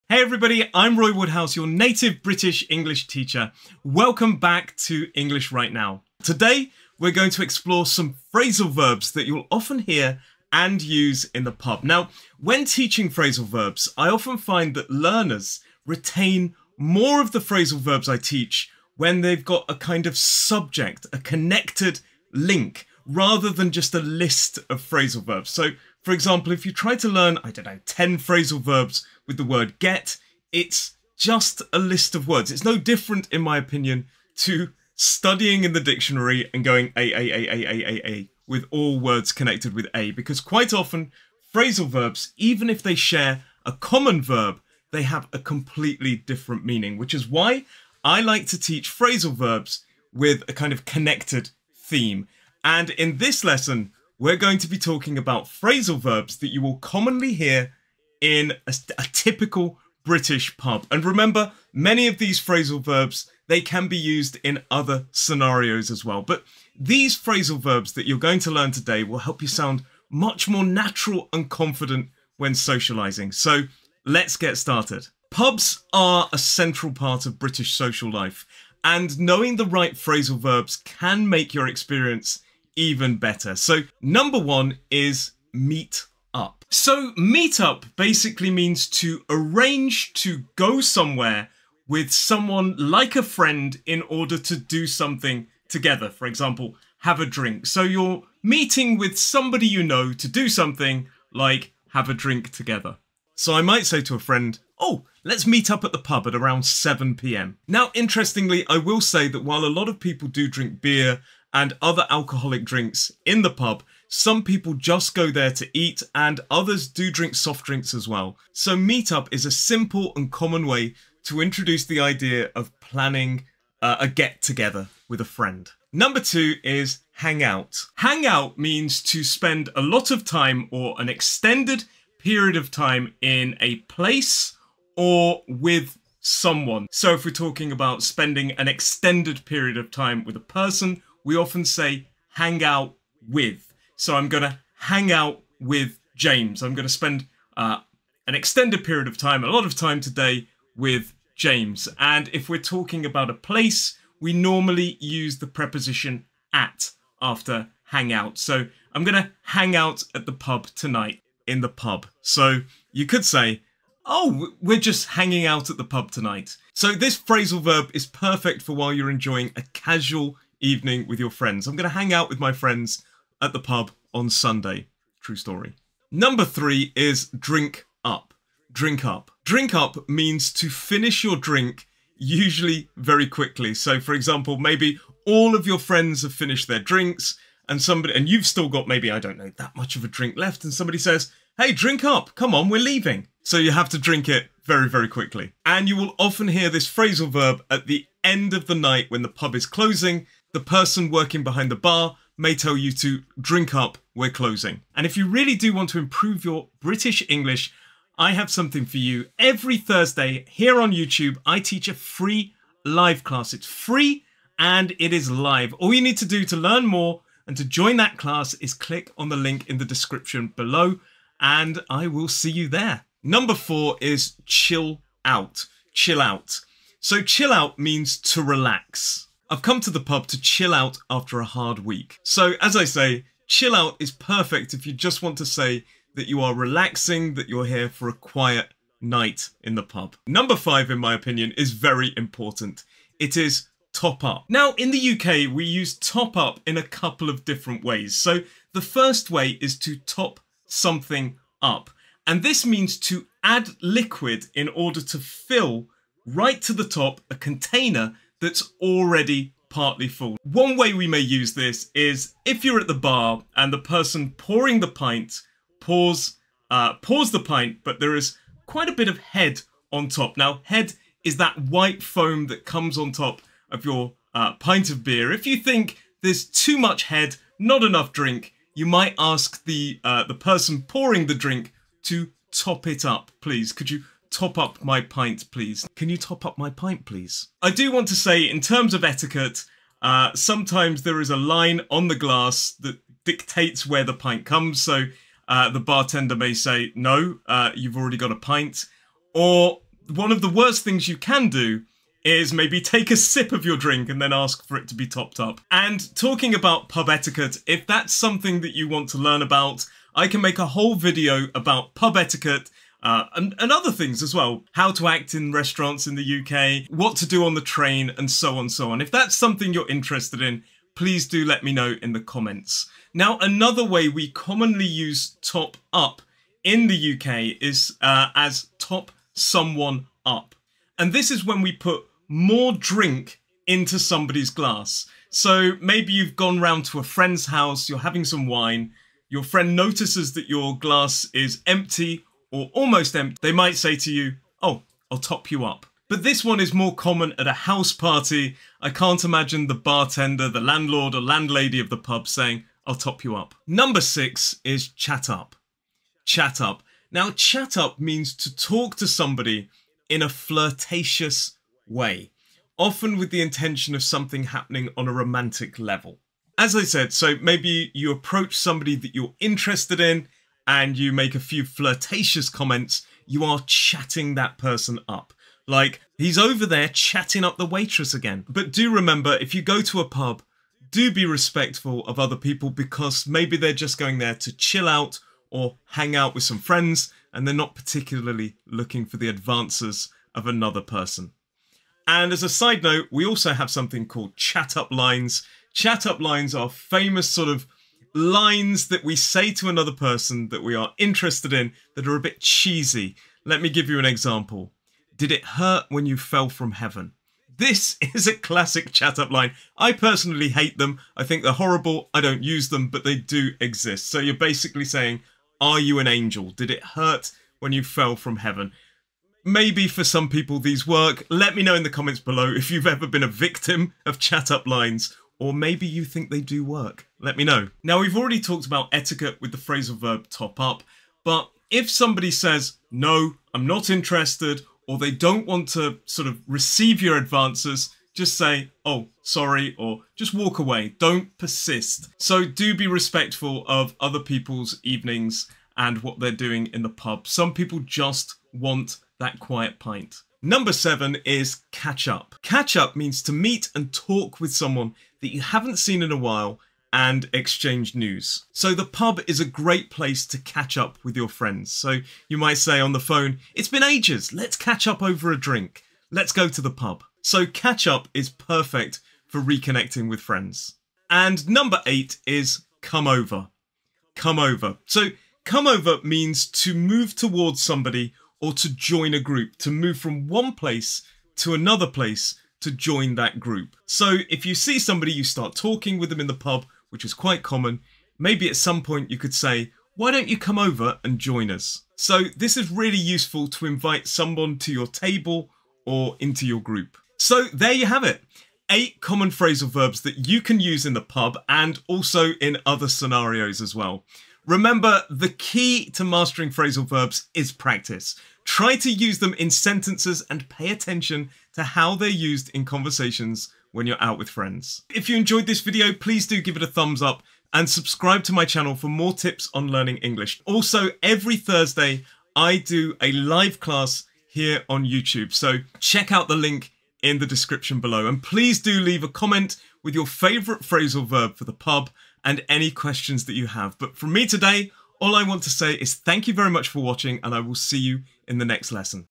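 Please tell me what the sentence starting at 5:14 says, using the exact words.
How to act in restaurants in the UK, what to do on the train, and so on, so on.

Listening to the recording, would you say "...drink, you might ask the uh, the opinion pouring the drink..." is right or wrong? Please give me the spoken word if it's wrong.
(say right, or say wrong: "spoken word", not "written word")
wrong: "person", not "opinion".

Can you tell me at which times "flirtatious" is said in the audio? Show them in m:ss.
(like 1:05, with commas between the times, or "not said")
6:00, 6:11.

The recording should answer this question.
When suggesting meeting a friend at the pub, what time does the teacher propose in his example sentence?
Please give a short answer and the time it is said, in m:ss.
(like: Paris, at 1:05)
7 p.m., at 1:46.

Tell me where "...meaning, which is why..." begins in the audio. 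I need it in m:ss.
0:46.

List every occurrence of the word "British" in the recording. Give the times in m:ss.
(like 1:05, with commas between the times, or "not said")
0:02, 1:00, 1:17, 3:26.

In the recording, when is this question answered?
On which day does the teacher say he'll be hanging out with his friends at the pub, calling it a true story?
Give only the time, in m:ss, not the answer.
2:54.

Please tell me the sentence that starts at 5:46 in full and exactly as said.
But this one is more common at a house party.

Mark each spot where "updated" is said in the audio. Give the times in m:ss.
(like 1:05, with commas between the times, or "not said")
not said.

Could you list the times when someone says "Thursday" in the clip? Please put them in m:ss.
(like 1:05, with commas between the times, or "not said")
3:29, 8:41.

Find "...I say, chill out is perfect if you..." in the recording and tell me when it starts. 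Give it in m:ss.
3:52.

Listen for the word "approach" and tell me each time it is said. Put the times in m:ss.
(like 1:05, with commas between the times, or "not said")
6:08.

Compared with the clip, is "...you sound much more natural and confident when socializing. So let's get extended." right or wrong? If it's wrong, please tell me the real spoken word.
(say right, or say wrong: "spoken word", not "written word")
wrong: "started", not "extended".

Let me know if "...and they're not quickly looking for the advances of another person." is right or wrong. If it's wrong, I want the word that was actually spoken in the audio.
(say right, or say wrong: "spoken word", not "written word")
wrong: "particularly", not "quickly".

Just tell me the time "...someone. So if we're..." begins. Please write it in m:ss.
2:16.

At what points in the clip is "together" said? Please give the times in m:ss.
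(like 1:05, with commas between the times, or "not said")
1:35, 1:42, 2:04.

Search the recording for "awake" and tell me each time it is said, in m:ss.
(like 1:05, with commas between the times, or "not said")
not said.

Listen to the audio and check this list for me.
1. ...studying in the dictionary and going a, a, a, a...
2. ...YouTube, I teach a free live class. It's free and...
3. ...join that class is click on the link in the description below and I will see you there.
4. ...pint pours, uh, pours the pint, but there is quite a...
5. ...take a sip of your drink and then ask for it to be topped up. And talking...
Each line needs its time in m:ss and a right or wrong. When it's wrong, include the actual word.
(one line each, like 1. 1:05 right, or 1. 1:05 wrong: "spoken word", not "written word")
1. 0:34 right
2. 3:30 right
3. 3:37 right
4. 4:24 right
5. 5:02 right.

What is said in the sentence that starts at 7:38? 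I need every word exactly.
So the pub is a great place to catch up with your friends.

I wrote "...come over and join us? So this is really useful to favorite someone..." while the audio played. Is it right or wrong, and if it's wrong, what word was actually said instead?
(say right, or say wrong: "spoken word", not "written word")
wrong: "invite", not "favorite".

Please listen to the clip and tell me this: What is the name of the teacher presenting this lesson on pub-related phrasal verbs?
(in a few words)
Roy Woodhouse.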